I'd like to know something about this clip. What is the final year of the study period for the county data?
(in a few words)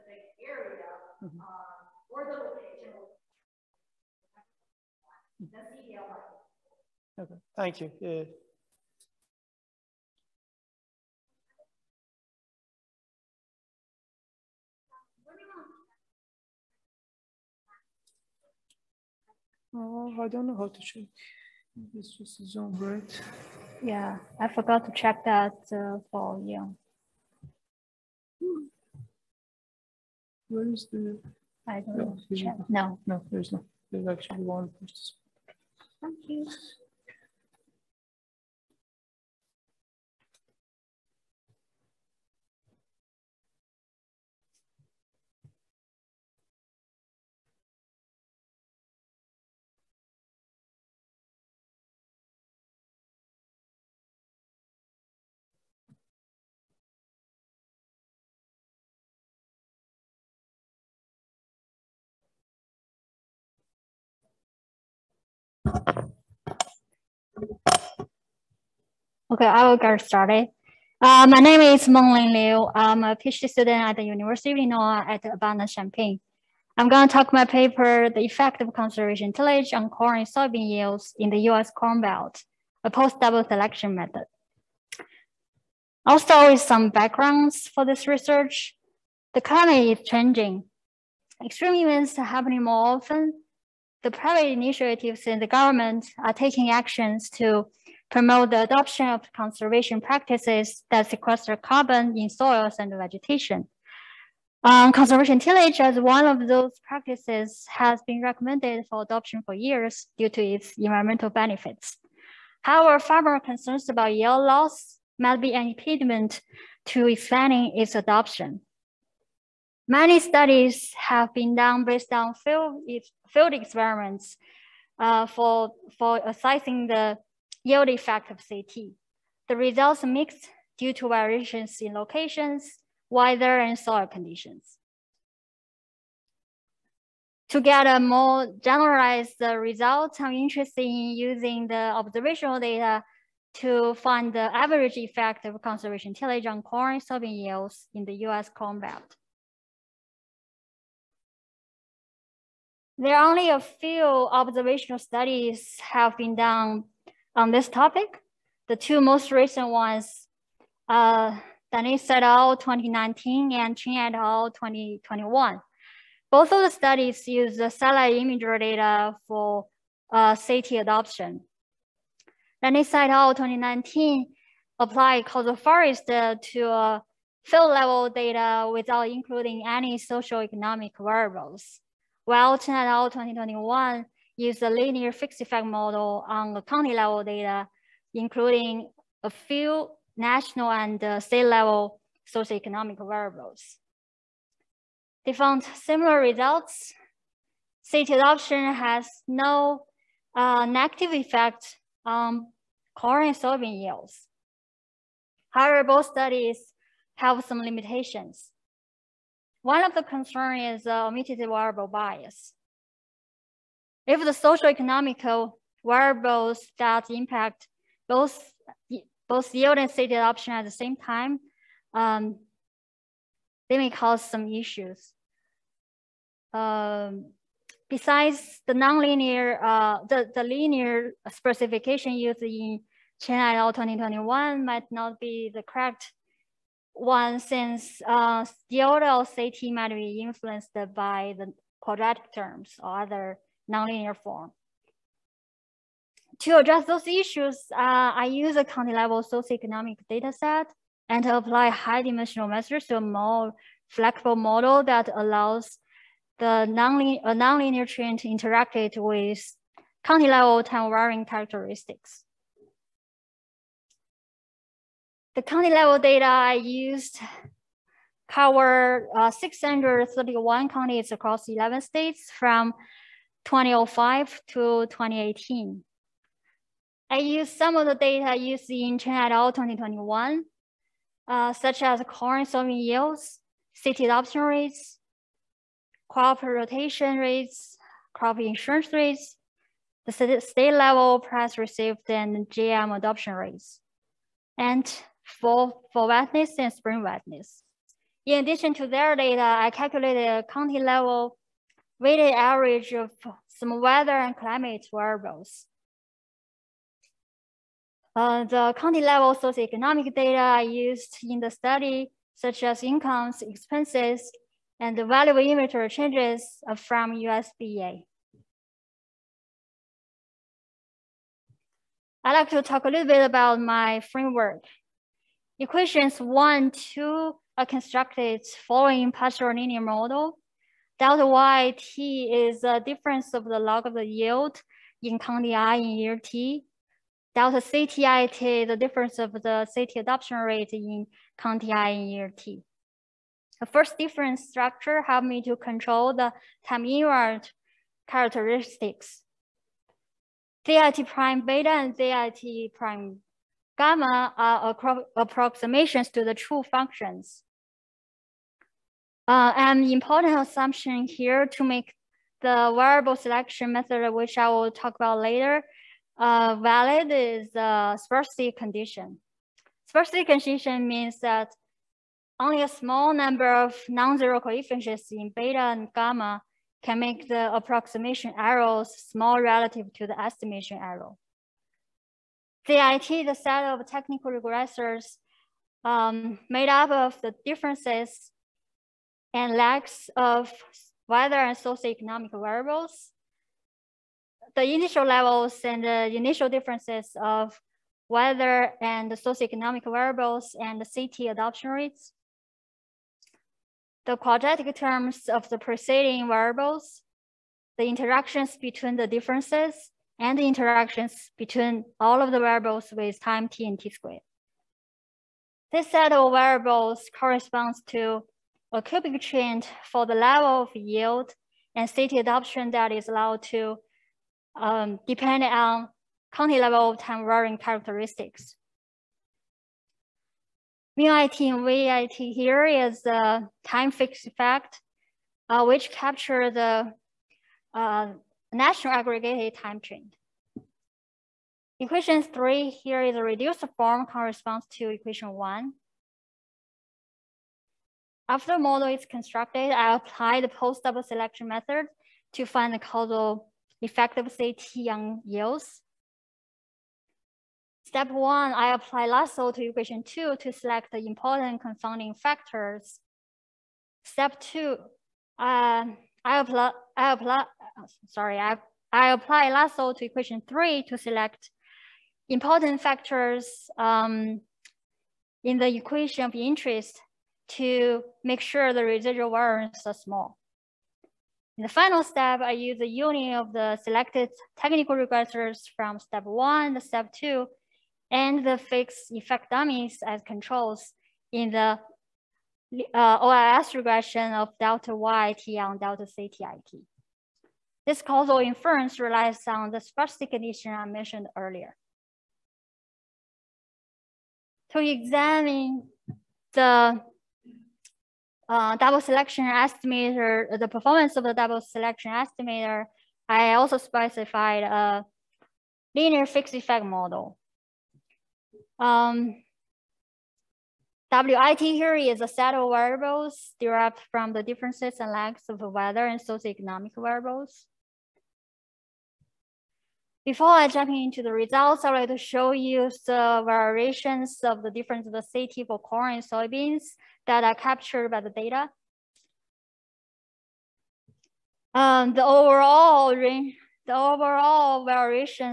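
2018.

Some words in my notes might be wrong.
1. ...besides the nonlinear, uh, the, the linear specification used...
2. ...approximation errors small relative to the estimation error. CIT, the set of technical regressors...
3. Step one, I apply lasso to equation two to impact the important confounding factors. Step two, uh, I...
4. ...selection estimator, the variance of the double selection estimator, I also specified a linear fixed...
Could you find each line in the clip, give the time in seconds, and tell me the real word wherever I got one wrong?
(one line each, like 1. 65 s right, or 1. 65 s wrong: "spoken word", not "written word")
1. 227 s right
2. 377 s right
3. 457 s wrong: "select", not "impact"
4. 508 s wrong: "performance", not "variance".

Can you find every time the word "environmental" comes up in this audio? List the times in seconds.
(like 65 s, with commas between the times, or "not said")
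110 s.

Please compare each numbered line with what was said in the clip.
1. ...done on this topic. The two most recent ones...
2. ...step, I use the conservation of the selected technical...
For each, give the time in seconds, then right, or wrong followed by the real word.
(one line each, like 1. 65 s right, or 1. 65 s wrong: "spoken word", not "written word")
1. 156 s right
2. 482 s wrong: "union", not "conservation".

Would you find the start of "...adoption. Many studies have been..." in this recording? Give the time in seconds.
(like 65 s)
117 s.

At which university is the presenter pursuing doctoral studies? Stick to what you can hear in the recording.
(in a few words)
University of Illinois at Urbana-Champaign.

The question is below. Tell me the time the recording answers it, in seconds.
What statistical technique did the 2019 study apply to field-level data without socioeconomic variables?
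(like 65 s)
175 s.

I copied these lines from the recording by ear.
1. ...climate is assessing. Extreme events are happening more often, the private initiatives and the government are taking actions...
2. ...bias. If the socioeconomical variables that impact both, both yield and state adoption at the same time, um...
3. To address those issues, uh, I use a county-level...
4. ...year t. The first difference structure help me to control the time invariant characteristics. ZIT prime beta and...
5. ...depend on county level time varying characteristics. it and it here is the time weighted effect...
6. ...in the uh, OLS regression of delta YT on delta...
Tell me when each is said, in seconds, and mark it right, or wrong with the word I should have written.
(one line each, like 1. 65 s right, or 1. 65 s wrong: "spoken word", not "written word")
1. 89 s wrong: "changing", not "assessing"
2. 211 s right
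3. 246 s right
4. 342 s right
5. 425 s wrong: "fixed", not "weighted"
6. 491 s right.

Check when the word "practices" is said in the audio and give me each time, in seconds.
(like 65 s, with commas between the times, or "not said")
99 s, 106 s.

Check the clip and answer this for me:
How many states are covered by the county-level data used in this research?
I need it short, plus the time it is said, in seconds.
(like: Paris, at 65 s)
11, at 271 s.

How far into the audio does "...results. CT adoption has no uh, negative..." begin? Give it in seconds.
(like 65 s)
196 s.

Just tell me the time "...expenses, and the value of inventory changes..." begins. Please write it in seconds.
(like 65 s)
313 s.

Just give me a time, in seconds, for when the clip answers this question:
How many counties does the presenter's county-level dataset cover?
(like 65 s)
269 s.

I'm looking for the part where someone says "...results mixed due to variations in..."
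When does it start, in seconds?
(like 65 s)
129 s.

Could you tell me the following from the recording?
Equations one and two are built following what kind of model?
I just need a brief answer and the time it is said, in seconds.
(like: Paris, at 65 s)
partial linear model, at 329 s.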